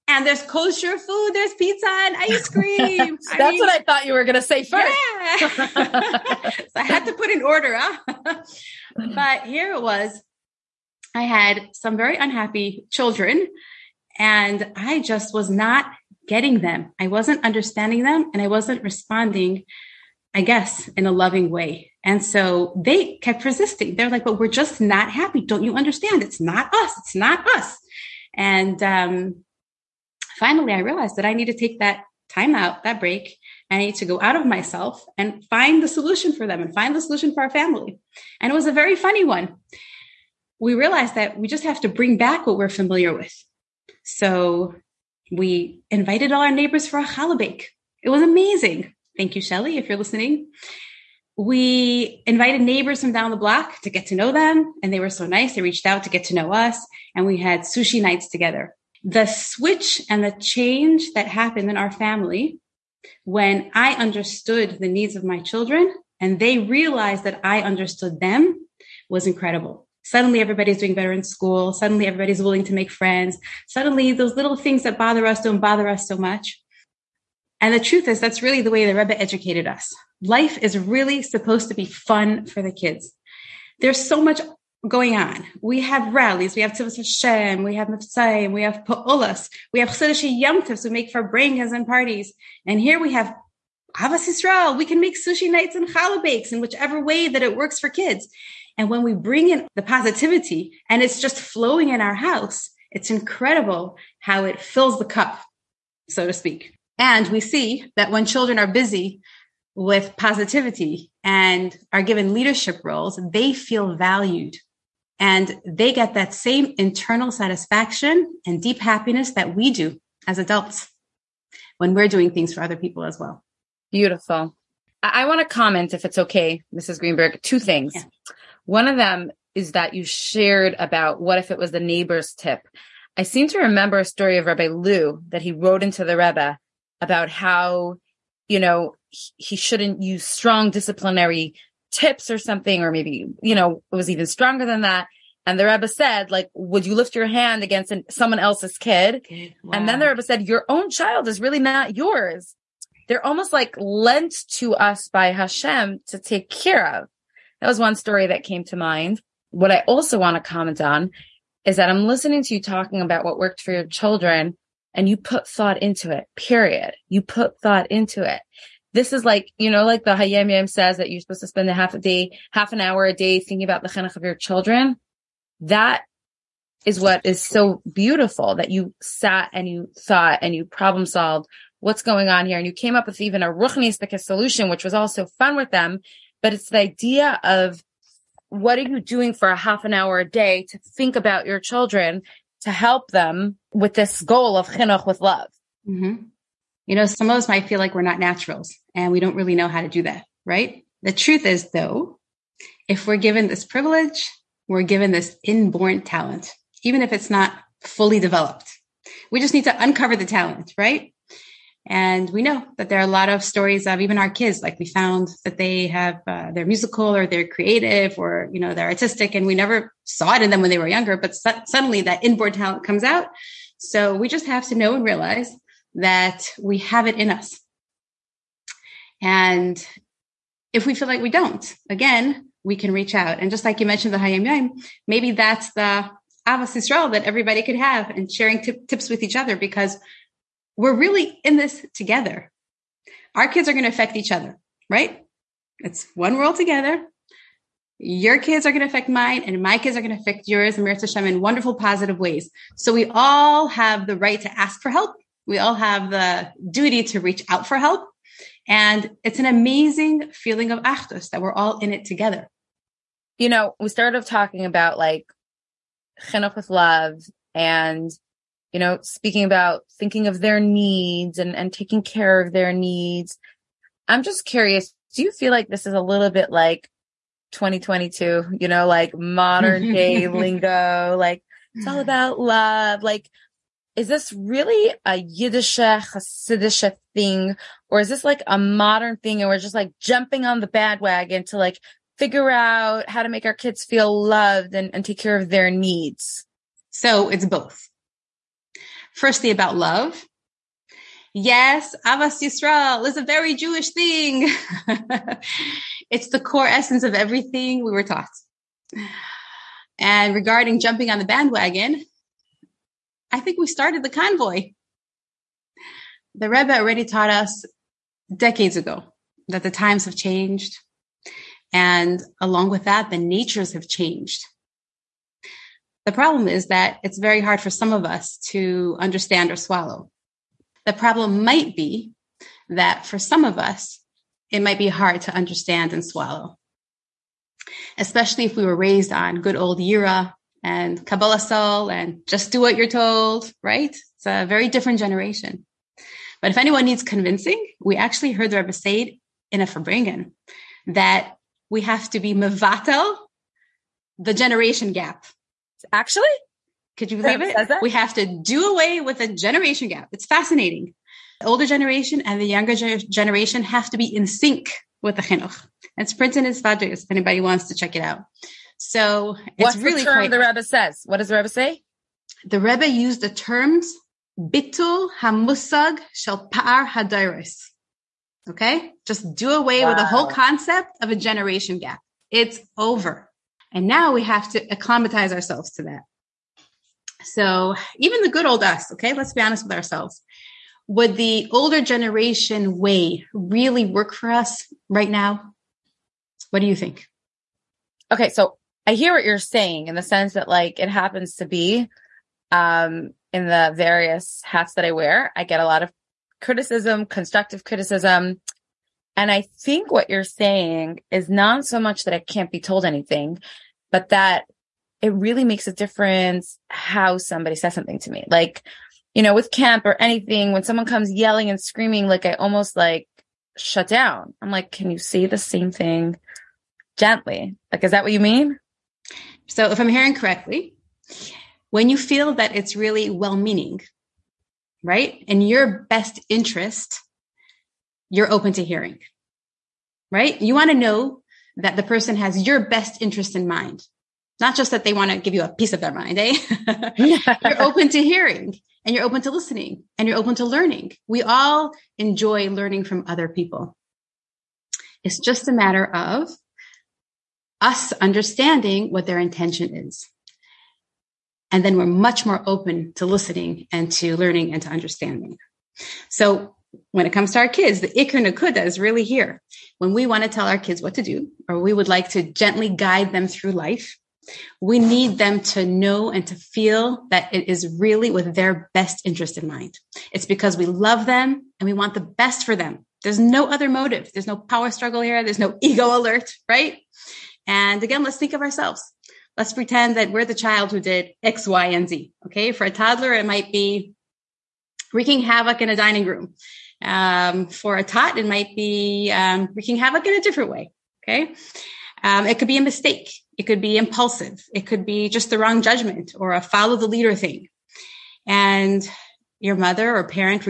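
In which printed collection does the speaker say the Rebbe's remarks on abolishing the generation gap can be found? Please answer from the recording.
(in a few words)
Svadris.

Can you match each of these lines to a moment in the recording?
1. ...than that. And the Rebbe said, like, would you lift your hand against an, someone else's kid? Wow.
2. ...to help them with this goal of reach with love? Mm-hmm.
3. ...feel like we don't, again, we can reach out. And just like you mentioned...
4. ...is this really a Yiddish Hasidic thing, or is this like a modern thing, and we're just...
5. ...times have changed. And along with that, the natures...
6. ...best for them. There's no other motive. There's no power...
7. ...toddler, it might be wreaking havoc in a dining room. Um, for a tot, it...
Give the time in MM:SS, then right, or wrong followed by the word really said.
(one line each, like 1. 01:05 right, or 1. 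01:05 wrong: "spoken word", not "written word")
1. 02:24 right
2. 03:12 wrong: "chinuch", not "reach"
3. 03:50 right
4. 04:43 right
5. 05:19 right
6. 08:02 right
7. 08:12 right.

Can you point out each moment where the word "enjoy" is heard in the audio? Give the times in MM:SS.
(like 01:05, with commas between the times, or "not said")
07:31.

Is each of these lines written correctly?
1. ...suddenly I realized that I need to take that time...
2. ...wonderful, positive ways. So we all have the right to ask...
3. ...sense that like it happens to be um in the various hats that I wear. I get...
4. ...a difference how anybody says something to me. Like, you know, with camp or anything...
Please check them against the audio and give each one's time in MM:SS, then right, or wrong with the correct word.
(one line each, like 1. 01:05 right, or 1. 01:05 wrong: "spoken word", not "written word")
1. 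00:30 wrong: "finally", not "suddenly"
2. 04:11 right
3. 06:40 right
4. 06:55 wrong: "somebody", not "anybody".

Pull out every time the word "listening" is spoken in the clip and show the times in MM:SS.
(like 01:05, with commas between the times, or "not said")
00:49, 02:42, 07:29, 07:43.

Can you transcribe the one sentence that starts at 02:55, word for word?
That is what is so beautiful that you sat and you thought and you problem solved what's going on here.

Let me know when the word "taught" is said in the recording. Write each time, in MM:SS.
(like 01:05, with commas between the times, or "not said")
05:08, 05:17.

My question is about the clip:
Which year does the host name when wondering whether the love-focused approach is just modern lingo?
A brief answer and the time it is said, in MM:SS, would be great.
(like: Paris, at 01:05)
2022, at 04:37.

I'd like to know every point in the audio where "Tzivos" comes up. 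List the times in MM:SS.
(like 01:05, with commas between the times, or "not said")
01:26.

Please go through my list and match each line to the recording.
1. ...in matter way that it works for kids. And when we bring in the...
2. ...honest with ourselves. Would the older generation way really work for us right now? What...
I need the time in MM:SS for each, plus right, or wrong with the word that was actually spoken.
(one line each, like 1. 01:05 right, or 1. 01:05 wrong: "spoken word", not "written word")
1. 01:36 wrong: "whichever", not "matter"
2. 06:29 right.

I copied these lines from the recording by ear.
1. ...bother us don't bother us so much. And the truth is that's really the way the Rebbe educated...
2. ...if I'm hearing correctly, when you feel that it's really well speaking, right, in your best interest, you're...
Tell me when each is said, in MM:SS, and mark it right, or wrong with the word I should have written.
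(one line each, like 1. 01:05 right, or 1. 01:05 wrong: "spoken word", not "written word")
1. 01:14 right
2. 07:09 wrong: "meaning", not "speaking".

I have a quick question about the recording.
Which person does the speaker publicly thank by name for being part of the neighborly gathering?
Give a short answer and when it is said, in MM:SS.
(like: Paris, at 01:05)
Shelly, at 00:49.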